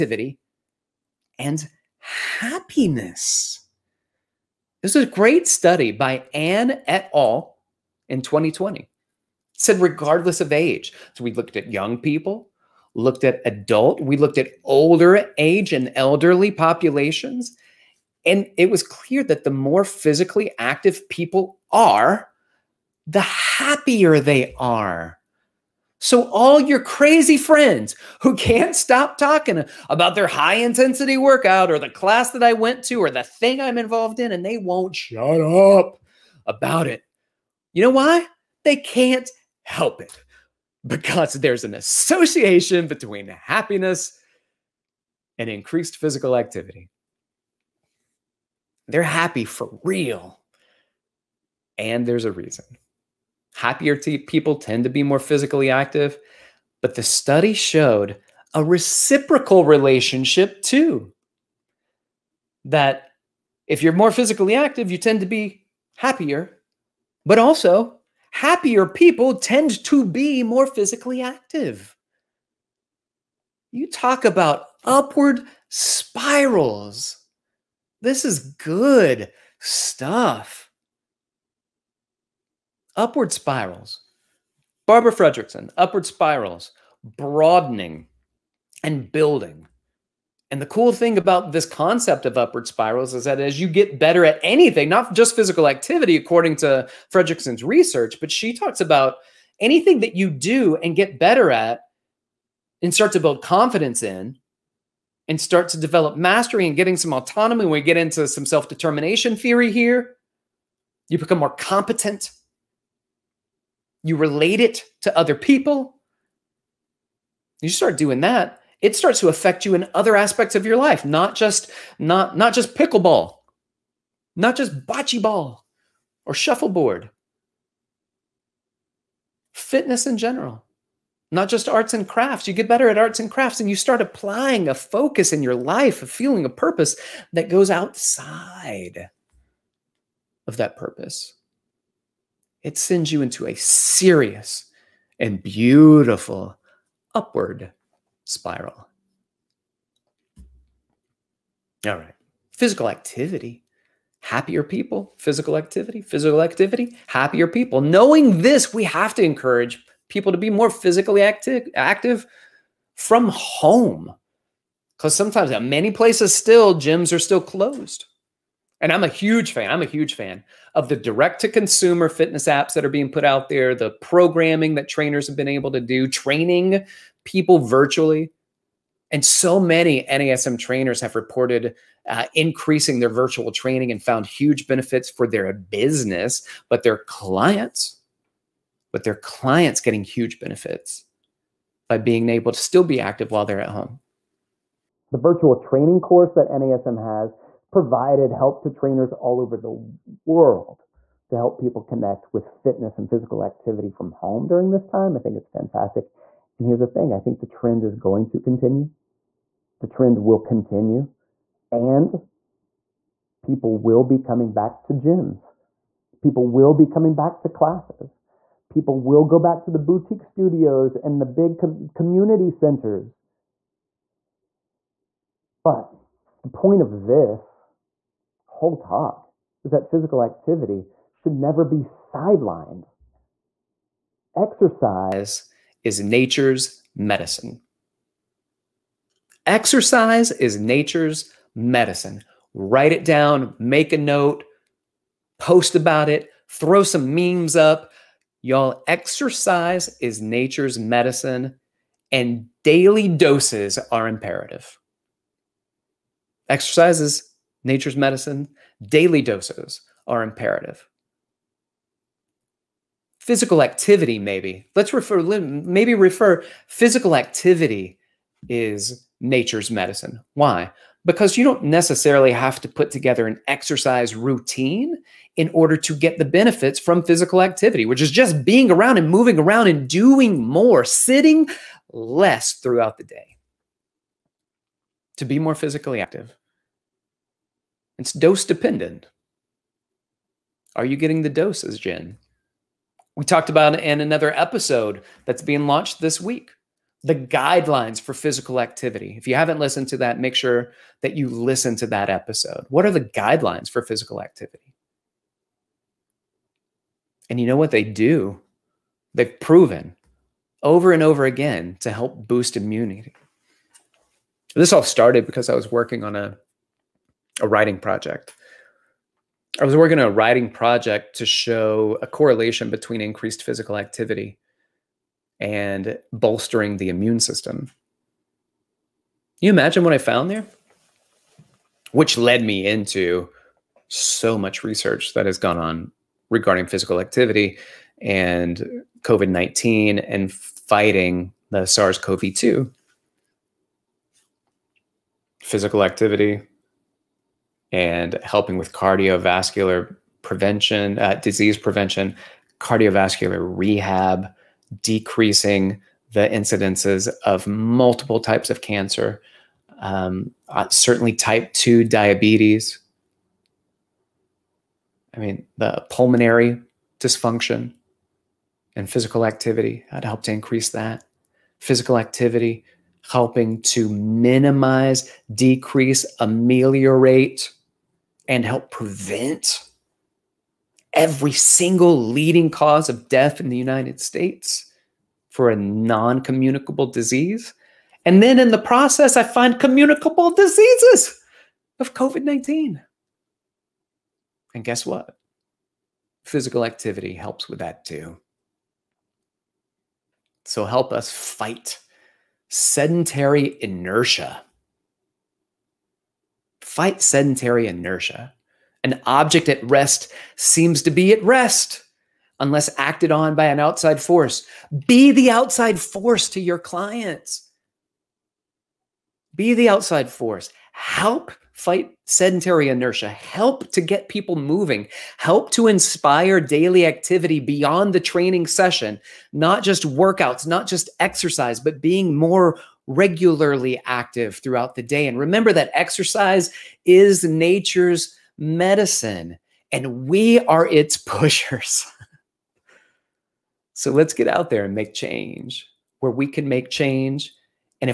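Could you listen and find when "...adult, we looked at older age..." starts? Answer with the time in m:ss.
0:13.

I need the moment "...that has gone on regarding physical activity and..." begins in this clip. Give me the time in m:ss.
5:35.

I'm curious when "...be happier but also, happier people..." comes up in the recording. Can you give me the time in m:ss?
1:05.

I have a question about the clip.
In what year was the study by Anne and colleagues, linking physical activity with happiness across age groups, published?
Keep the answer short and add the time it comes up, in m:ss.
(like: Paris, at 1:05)
2020, at 0:08.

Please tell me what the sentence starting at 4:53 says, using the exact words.
We talked about it in another episode that's being launched this week the guidelines for physical activity.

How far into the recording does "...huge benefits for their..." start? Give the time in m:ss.
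3:04.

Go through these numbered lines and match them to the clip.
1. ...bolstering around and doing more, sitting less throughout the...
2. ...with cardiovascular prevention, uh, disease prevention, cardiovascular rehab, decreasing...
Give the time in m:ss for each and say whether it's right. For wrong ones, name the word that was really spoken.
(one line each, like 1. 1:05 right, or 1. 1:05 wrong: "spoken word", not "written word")
1. 4:39 wrong: "moving", not "bolstering"
2. 5:48 right.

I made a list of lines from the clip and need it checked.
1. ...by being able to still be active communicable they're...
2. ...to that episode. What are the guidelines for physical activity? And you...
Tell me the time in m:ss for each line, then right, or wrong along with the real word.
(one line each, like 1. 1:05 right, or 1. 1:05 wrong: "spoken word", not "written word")
1. 3:11 wrong: "while", not "communicable"
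2. 5:01 right.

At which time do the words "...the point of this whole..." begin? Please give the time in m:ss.
3:46.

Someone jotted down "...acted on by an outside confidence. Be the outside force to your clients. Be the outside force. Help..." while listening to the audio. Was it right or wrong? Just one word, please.
wrong.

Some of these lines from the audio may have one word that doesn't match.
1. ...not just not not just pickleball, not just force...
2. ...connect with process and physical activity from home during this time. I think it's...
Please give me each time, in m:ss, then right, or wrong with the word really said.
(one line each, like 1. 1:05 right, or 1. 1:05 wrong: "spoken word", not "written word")
1. 2:01 wrong: "bocce", not "force"
2. 3:21 wrong: "fitness", not "process".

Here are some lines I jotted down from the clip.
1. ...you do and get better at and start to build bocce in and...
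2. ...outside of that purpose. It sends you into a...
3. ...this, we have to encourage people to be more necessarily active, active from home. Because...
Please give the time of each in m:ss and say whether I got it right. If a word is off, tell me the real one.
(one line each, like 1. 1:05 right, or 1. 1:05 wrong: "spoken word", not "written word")
1. 1:40 wrong: "confidence", not "bocce"
2. 2:17 right
3. 2:38 wrong: "physically", not "necessarily".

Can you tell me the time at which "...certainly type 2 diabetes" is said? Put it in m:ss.
6:00.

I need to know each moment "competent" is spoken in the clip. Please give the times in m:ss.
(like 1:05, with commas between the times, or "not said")
1:51.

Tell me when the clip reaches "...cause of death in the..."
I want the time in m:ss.
6:22.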